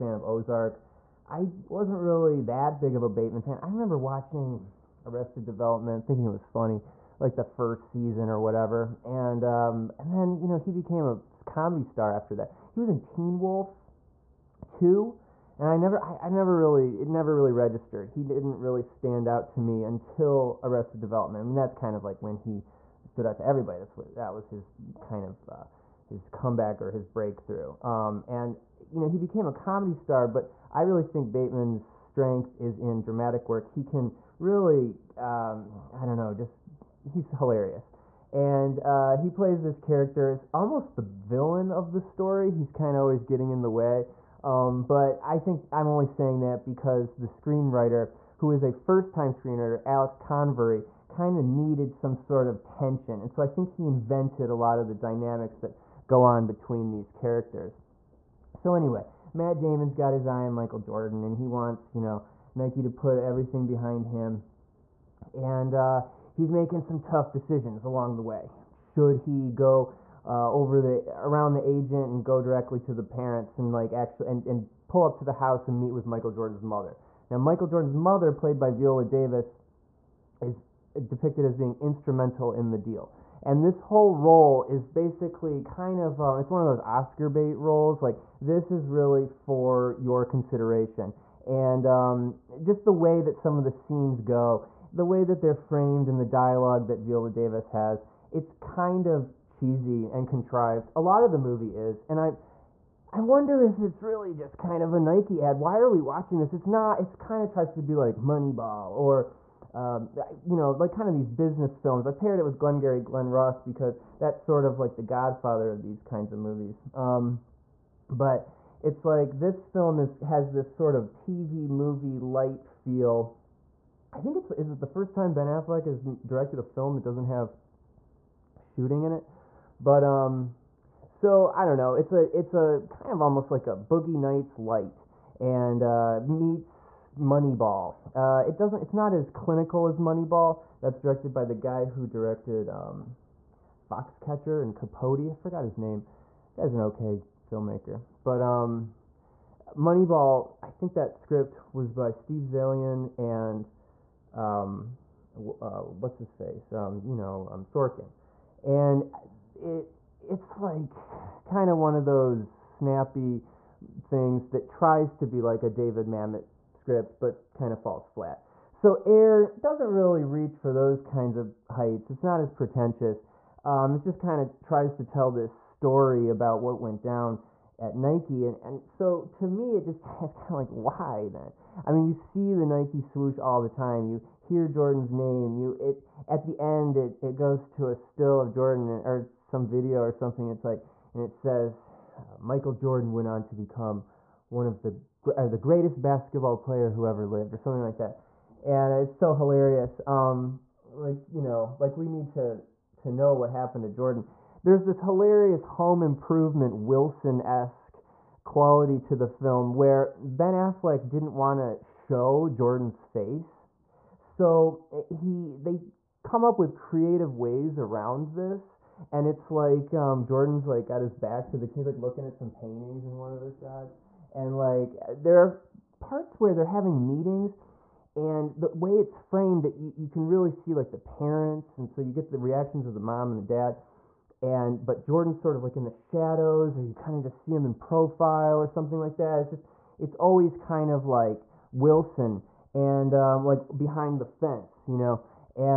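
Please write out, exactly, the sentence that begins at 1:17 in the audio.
Now, Michael Jordan's mother, played by Viola Davis, is depicted as being instrumental in the deal.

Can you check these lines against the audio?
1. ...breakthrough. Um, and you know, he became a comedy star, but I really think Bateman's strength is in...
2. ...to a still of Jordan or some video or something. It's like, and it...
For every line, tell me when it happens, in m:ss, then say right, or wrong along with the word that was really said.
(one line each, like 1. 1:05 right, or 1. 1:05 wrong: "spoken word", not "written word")
1. 0:27 right
2. 3:07 right.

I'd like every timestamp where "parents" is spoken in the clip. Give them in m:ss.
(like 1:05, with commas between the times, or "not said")
1:13, 3:50.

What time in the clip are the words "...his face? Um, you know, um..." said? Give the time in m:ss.
2:36.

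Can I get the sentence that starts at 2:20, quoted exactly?
That's directed by the guy who directed um, Foxcatcher and Capote.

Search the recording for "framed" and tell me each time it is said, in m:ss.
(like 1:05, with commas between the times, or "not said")
1:35, 3:49.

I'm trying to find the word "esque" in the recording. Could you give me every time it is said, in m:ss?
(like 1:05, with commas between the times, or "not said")
3:27.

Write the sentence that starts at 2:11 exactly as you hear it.
It's a it's a kind of almost like a Boogie Nights light and uh, meets Moneyball.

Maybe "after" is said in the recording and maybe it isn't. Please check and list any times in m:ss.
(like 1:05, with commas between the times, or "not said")
0:12.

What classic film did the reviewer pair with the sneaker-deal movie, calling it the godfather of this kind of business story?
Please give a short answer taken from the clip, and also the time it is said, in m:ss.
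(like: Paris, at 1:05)
Glengarry Glen Ross, at 1:52.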